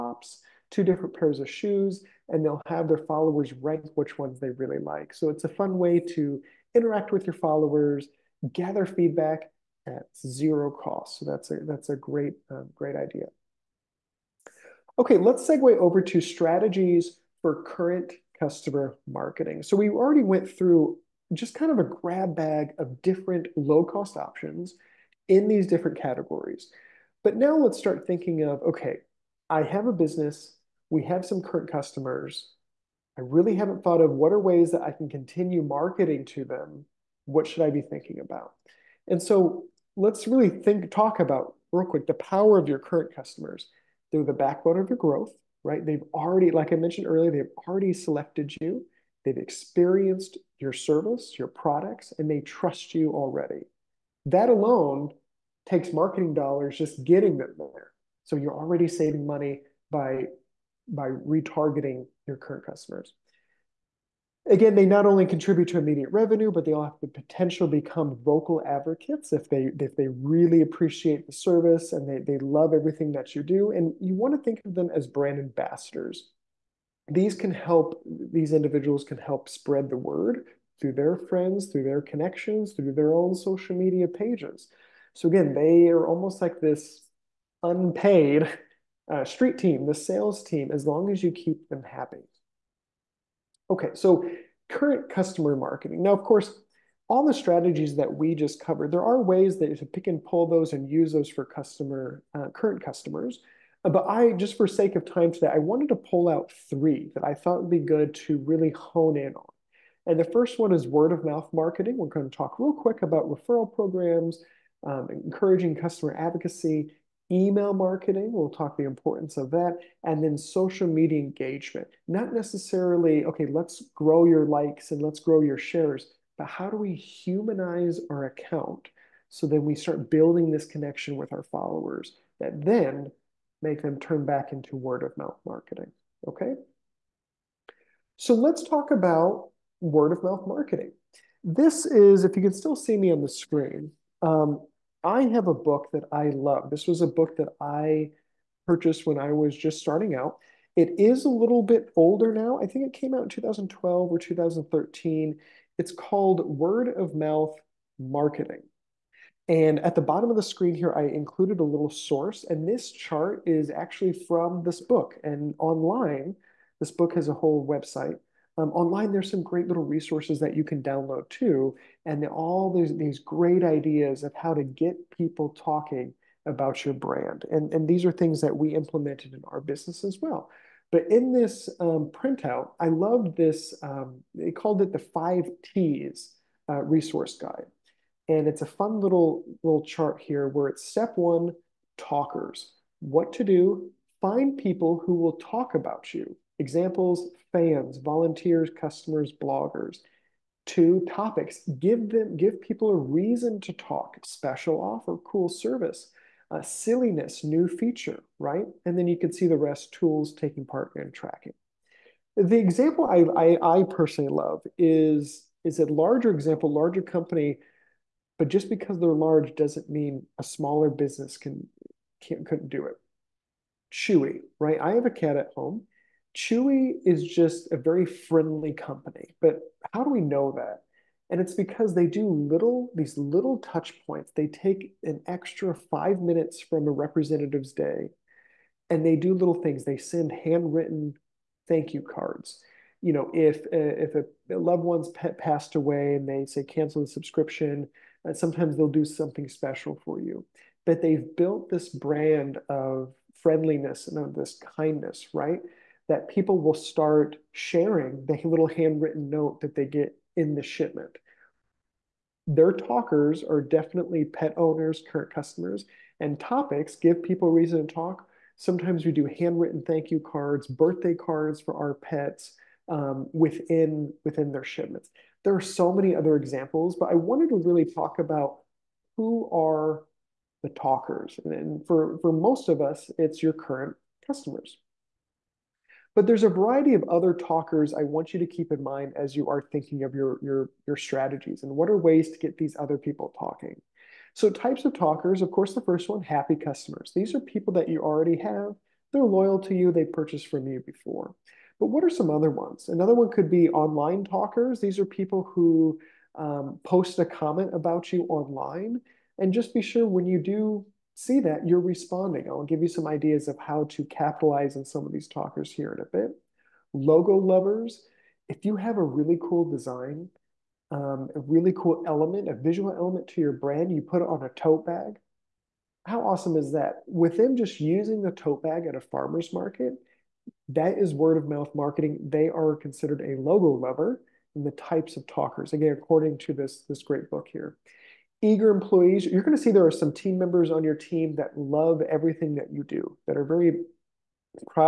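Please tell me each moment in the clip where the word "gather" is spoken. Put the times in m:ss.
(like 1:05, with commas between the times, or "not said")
0:08.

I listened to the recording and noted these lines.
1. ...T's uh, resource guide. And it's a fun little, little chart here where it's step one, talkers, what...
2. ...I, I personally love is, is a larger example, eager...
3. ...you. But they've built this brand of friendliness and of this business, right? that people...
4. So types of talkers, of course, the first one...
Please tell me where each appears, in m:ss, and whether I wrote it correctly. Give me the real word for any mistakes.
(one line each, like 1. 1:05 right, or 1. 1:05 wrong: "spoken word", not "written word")
1. 3:05 right
2. 3:33 wrong: "larger", not "eager"
3. 4:10 wrong: "kindness", not "business"
4. 4:54 right.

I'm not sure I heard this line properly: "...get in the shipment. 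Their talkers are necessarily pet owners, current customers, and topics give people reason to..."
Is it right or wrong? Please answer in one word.
wrong.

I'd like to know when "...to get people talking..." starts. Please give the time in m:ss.
2:54.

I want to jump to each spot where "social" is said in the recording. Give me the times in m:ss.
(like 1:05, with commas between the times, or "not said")
1:23, 2:00.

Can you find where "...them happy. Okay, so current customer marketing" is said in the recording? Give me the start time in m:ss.
1:31.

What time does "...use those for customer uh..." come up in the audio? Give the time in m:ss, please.
1:40.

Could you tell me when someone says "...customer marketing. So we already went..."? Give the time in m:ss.
0:18.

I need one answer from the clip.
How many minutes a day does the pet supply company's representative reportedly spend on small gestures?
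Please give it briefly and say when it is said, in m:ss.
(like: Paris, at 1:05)
5, at 3:55.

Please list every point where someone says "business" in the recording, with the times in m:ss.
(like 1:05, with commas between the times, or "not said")
0:29, 2:59, 3:40.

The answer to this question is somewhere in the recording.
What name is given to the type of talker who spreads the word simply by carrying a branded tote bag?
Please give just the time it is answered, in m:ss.
5:16.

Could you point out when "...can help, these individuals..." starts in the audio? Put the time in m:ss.
1:17.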